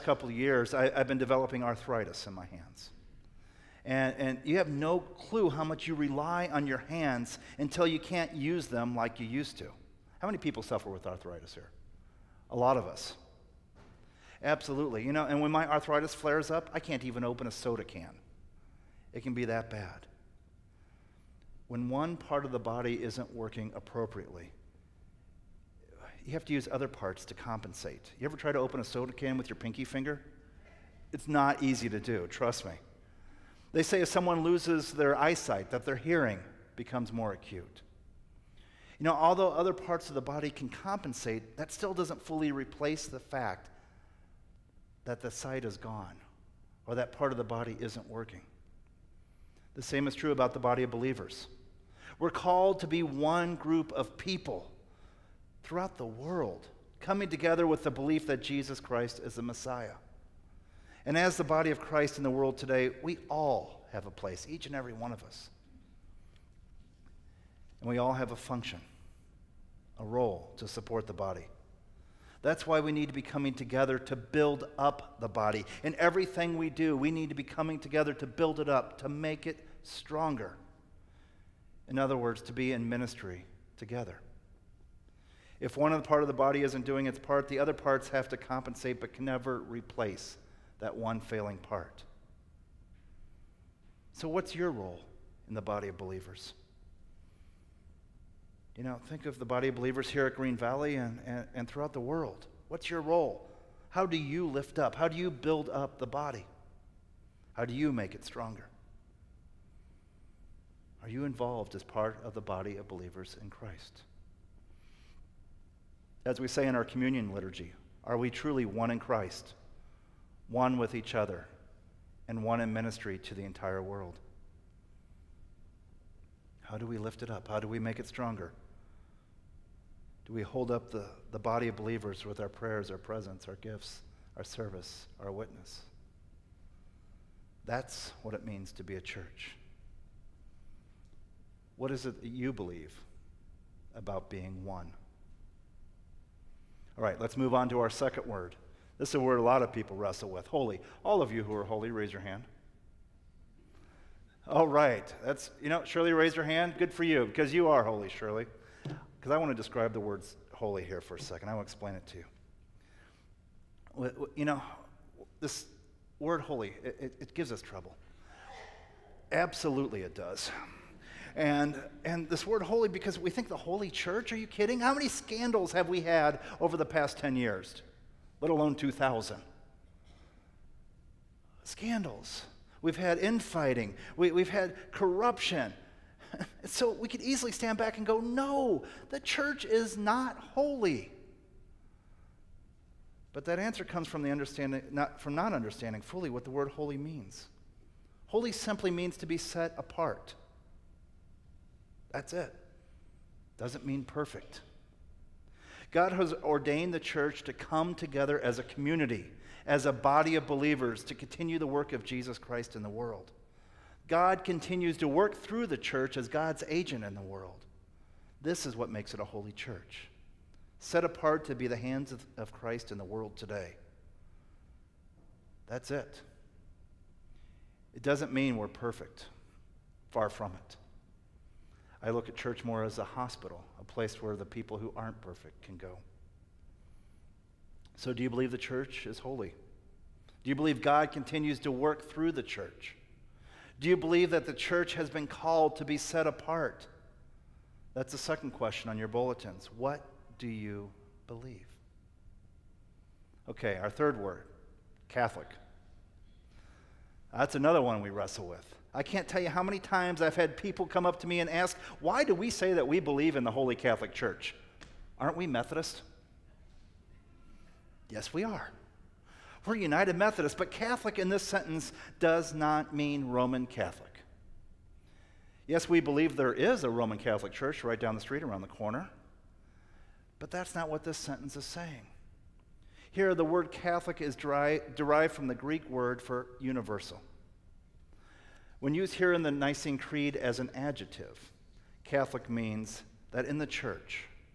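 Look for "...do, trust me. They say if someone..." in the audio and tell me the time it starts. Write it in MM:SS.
00:31.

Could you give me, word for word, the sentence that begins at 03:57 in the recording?
So, do you believe the church is holy?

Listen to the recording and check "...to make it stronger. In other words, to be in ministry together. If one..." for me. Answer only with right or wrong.
right.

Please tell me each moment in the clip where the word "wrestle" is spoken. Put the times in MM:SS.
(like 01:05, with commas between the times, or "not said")
02:29, 04:18.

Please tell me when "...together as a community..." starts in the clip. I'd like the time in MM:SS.
03:27.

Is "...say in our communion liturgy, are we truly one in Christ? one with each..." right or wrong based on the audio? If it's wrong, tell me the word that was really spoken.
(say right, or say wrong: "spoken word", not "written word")
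right.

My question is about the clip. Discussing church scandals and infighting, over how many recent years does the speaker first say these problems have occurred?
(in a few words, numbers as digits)
10 years.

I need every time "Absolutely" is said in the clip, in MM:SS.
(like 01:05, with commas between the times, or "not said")
00:14, 02:49.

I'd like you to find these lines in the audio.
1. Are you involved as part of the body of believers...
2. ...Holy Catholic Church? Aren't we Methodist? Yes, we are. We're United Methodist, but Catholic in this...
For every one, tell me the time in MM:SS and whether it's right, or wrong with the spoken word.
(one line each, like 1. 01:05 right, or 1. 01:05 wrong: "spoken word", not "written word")
1. 01:51 right
2. 04:23 right.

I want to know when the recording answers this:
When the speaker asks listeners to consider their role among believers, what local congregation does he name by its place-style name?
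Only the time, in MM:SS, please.
01:40.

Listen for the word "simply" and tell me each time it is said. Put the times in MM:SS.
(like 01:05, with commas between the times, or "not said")
03:18.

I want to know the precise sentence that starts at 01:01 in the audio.
And as the body of Christ in the world today, we all have a place, each and every one of us.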